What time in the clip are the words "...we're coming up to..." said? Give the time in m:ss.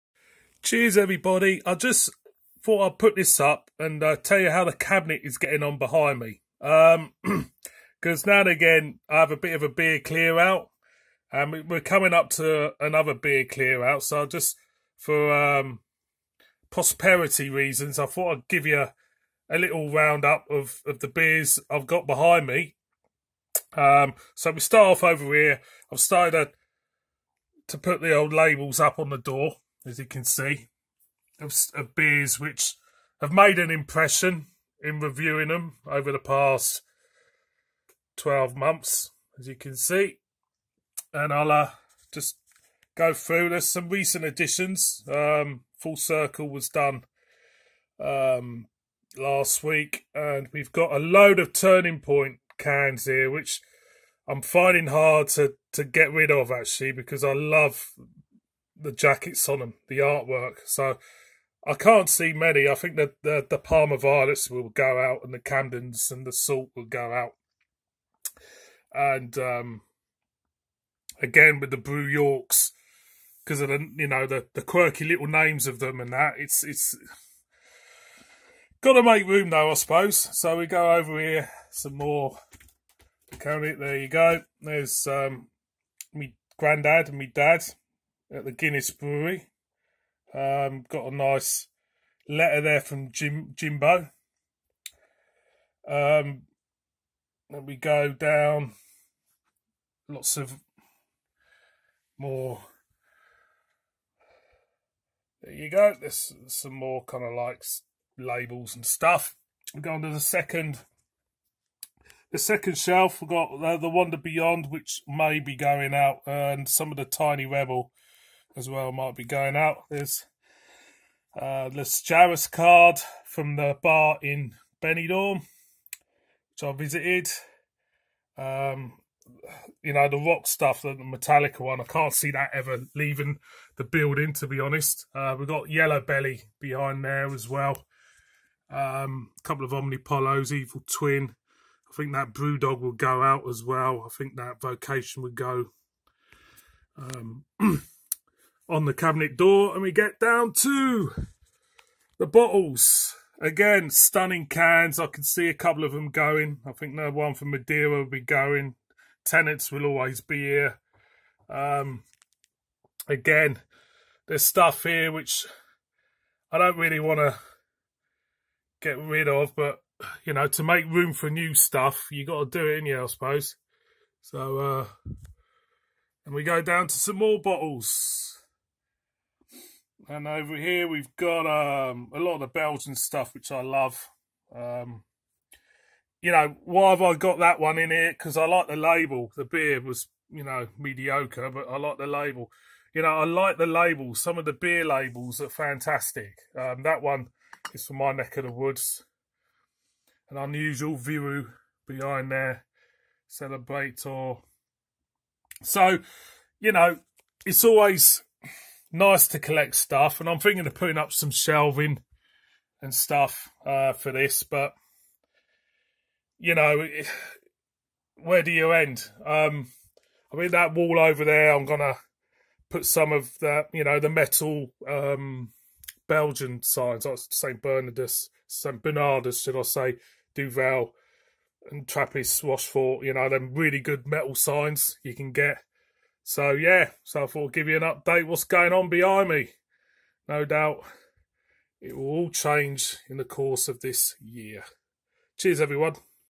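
0:11.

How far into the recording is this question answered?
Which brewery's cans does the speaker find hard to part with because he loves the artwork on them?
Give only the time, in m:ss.
0:51.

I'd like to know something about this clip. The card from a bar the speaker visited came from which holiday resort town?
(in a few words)
Benidorm.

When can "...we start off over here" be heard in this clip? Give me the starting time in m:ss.
0:24.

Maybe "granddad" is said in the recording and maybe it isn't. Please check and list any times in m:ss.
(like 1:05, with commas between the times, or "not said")
1:26.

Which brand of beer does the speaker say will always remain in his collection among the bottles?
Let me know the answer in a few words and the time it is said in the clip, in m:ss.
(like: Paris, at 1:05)
Tennent's, at 2:39.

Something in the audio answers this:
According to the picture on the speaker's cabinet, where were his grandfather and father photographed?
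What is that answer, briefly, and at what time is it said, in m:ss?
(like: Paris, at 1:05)
Guinness Brewery, at 1:28.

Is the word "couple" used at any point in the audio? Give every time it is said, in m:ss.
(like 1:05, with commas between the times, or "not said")
2:19, 2:35.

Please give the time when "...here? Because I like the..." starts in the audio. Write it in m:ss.
3:07.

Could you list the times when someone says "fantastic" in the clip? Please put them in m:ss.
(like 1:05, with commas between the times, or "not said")
3:15.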